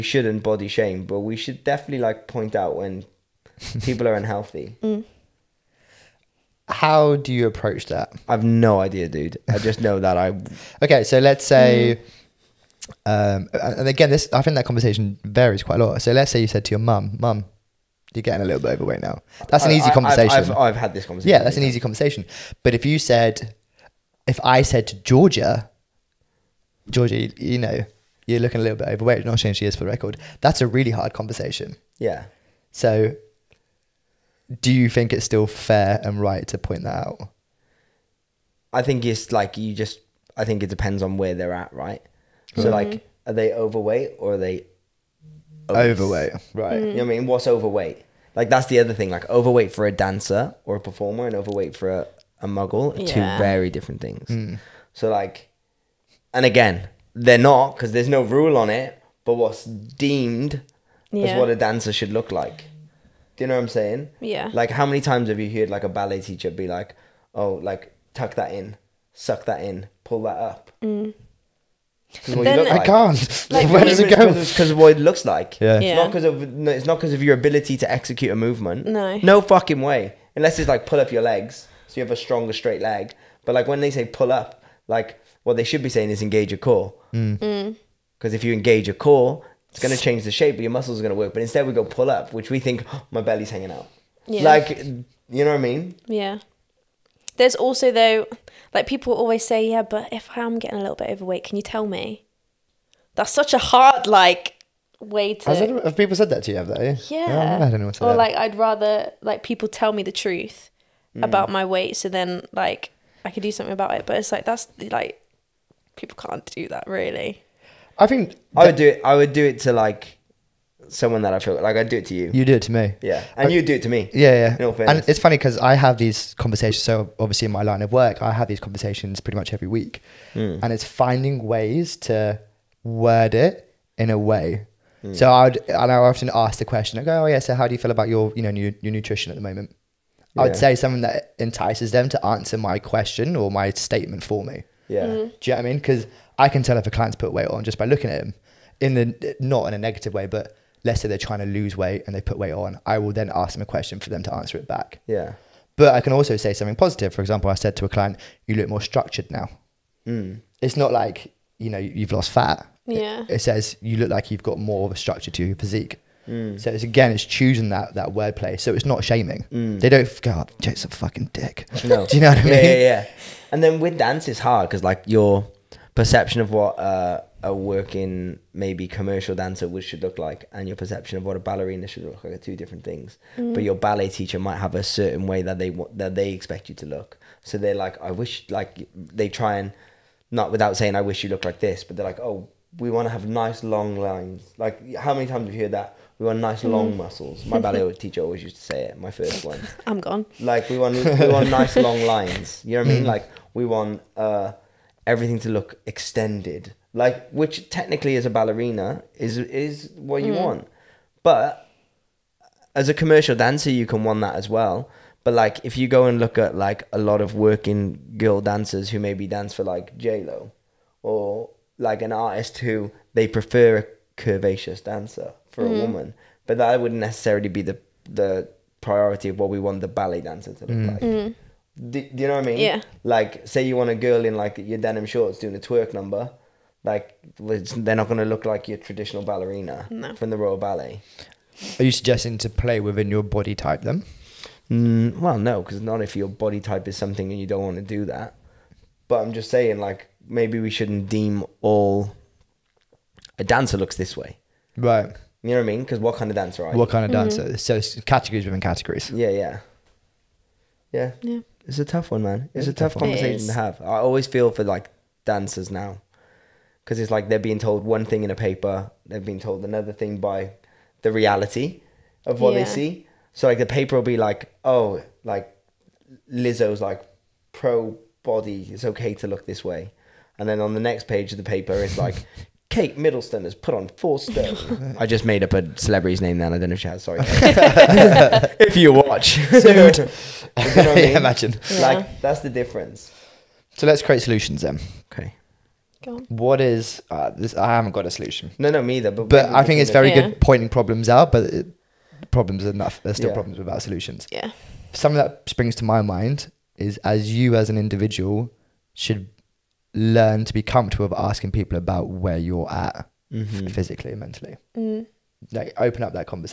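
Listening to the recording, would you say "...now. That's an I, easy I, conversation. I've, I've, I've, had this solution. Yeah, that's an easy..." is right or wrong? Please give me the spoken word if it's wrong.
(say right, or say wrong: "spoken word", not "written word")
wrong: "conversation", not "solution".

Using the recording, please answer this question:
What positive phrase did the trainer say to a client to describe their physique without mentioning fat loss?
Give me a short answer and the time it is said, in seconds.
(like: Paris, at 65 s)
more structured, at 158 s.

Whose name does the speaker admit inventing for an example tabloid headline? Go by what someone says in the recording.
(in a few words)
Kate Middleton.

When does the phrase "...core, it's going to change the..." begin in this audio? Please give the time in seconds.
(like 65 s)
88 s.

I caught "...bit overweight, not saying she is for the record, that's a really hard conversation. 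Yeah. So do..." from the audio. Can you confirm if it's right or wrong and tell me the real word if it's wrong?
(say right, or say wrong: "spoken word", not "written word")
right.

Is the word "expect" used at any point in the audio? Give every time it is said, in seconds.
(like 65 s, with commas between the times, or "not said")
186 s.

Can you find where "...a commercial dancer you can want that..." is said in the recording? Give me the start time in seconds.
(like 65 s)
212 s.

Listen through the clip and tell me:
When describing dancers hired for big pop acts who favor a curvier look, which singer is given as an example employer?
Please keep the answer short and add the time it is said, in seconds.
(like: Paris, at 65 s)
J-Lo, at 219 s.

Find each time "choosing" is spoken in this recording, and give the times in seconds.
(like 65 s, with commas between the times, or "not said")
167 s.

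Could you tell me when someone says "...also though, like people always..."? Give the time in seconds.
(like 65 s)
97 s.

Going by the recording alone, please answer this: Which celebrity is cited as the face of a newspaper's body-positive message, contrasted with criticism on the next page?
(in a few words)
Lizzo.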